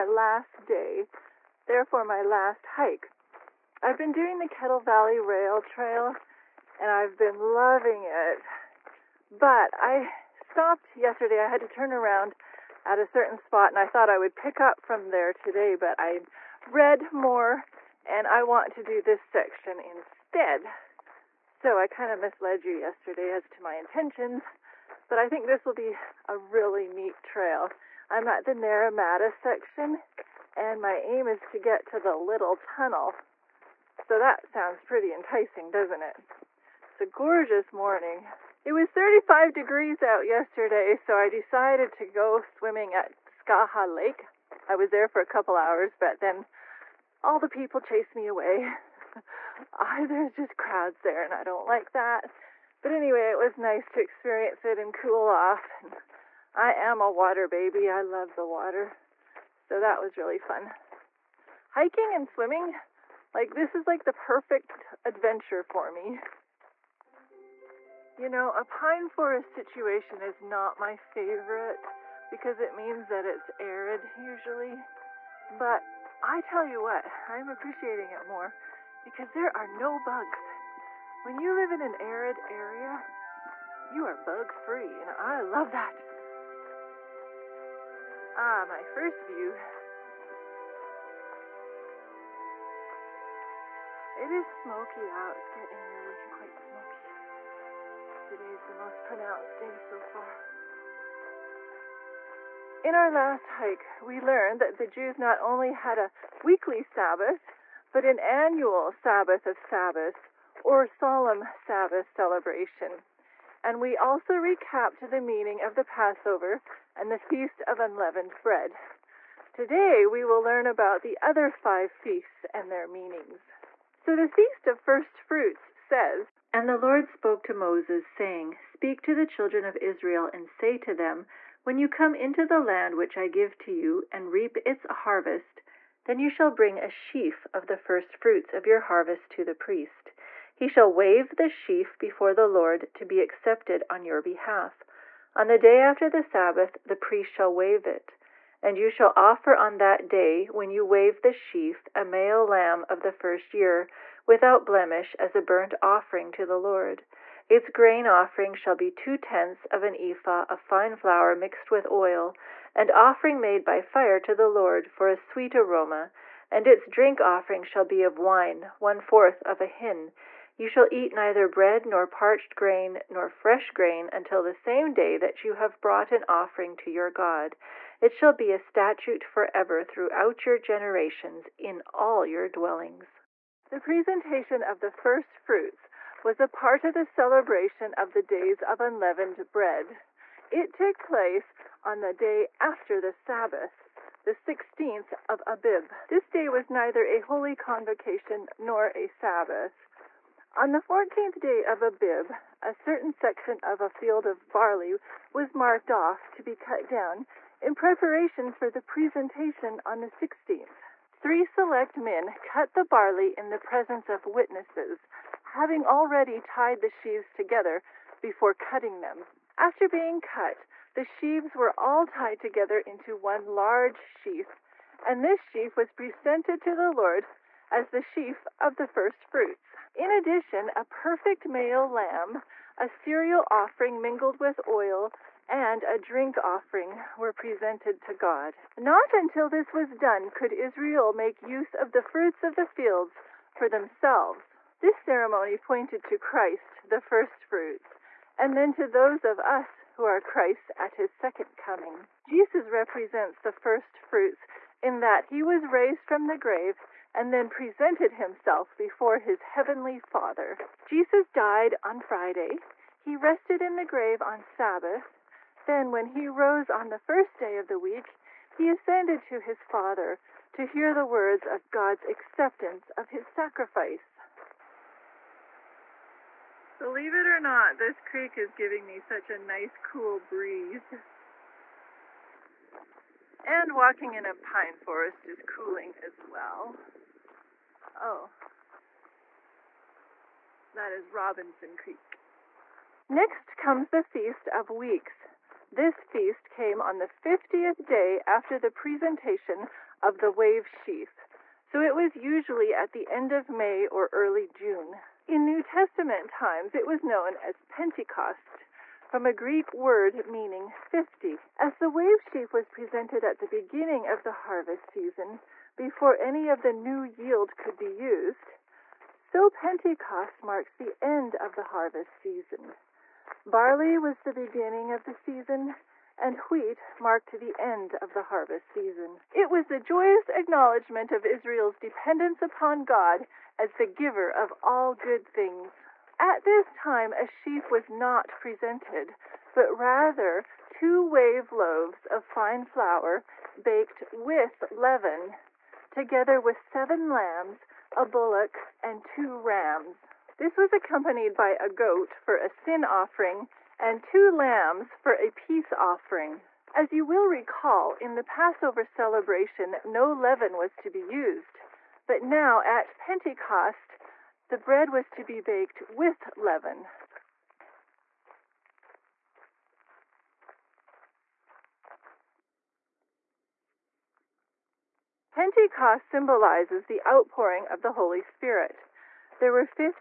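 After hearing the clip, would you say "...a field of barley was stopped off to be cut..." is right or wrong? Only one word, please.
wrong.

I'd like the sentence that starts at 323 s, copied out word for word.
Barley was the beginning of the season, and wheat marked the end of the harvest season.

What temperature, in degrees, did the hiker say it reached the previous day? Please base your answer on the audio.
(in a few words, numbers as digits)
35.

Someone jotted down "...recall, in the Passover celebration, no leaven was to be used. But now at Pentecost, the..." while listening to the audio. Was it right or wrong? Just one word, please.
right.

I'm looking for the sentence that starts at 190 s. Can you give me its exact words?
It took place on the day after the Sabbath, the 16th of Abib.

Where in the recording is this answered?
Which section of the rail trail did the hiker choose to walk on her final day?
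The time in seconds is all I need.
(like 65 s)
28 s.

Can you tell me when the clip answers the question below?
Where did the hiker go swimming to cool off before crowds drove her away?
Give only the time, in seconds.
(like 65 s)
43 s.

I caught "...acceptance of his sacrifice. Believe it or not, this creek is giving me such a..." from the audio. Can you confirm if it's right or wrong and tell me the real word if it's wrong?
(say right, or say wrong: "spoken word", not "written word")
right.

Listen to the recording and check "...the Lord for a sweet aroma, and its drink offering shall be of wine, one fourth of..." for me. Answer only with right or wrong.
right.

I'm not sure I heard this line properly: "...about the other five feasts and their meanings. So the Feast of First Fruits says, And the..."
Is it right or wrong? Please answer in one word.
right.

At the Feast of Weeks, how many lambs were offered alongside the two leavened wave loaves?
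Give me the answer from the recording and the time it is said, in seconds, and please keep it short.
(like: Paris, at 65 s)
7, at 346 s.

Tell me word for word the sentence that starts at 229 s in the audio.
In addition, a perfect male lamb, a cereal offering mingled with oil, and a drink offering were presented to God.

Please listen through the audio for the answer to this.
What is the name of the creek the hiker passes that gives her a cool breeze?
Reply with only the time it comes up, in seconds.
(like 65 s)
291 s.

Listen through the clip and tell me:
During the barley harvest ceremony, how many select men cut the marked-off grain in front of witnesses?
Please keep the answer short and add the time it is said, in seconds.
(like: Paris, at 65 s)
3, at 211 s.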